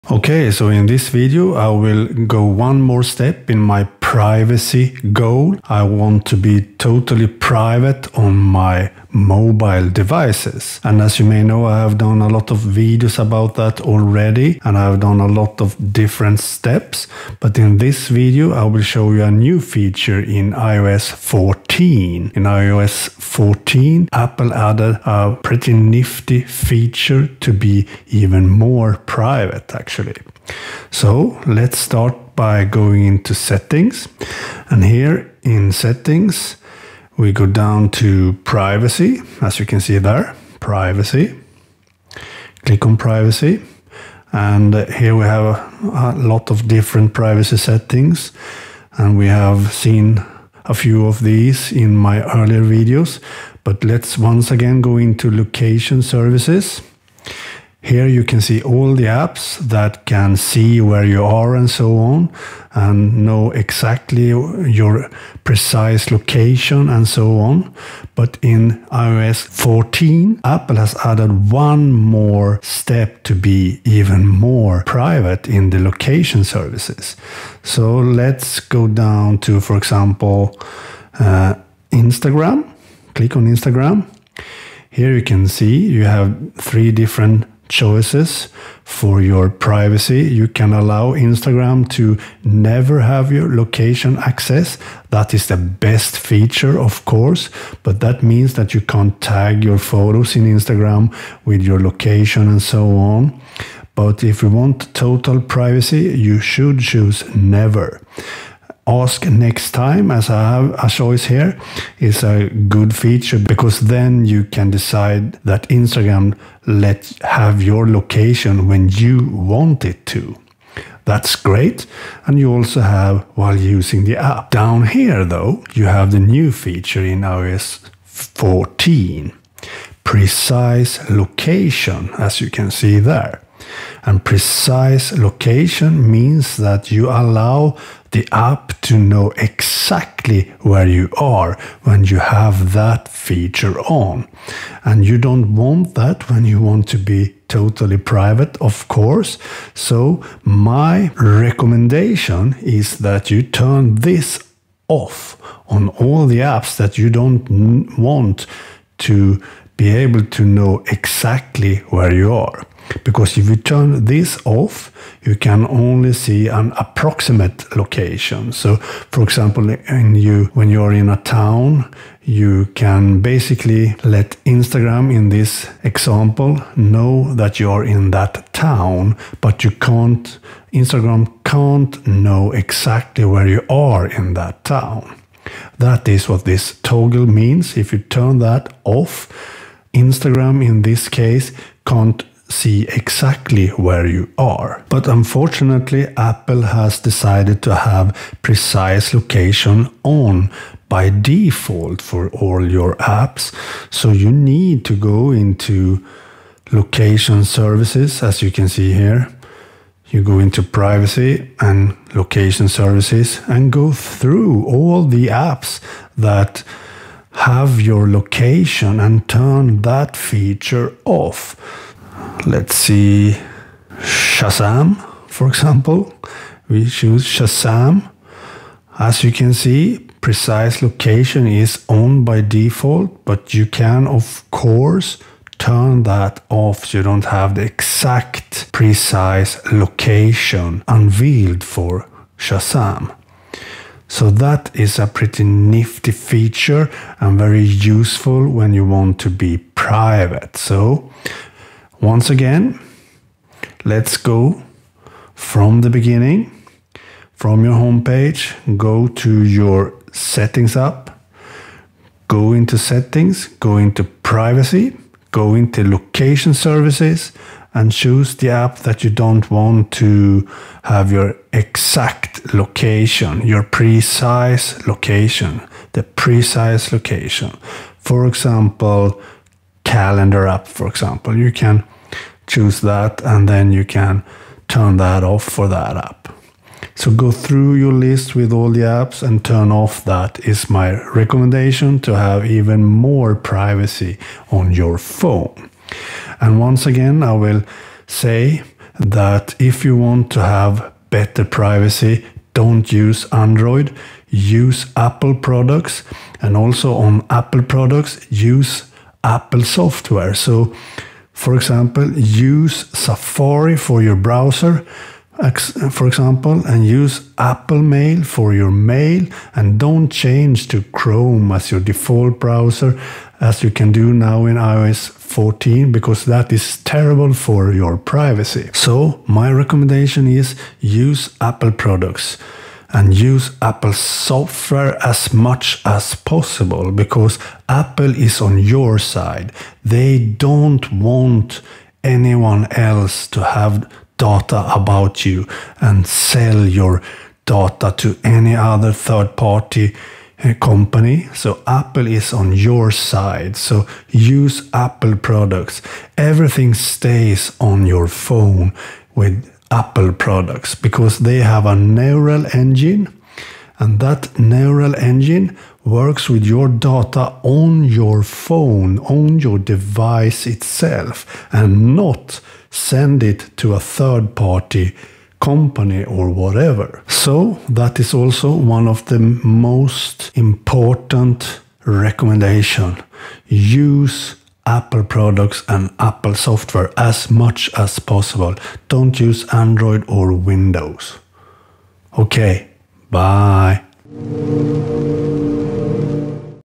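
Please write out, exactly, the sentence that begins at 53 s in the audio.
But let's once again go into location services.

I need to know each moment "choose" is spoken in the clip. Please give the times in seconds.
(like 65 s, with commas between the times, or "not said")
106 s, 226 s, 267 s, 282 s.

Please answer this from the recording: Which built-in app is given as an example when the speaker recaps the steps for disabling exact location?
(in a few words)
Calendar.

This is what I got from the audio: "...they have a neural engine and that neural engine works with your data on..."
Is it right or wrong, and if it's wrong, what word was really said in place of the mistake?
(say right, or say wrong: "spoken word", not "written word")
right.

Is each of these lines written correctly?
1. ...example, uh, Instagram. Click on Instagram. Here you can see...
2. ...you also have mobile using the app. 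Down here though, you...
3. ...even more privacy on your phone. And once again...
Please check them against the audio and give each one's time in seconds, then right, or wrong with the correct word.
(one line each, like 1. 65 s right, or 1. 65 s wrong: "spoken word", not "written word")
1. 79 s right
2. 122 s wrong: "while", not "mobile"
3. 292 s right.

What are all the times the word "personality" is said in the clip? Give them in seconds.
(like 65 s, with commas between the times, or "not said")
not said.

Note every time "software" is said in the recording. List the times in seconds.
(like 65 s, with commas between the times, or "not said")
309 s, 333 s, 386 s.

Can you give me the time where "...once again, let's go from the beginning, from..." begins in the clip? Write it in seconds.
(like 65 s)
252 s.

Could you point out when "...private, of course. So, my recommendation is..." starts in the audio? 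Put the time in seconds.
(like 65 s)
147 s.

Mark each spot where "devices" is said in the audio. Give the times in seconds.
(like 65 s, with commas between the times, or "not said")
9 s, 369 s.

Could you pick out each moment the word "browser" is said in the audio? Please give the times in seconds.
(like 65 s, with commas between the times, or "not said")
314 s, 322 s.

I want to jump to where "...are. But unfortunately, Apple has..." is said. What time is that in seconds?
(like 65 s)
194 s.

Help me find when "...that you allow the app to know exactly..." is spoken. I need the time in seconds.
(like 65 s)
136 s.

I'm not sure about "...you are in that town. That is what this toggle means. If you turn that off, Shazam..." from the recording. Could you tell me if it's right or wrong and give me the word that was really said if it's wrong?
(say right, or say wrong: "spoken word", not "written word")
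wrong: "Instagram", not "Shazam".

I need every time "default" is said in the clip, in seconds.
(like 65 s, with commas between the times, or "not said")
201 s, 232 s, 321 s.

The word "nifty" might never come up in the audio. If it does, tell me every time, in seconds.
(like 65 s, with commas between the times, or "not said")
25 s, 245 s.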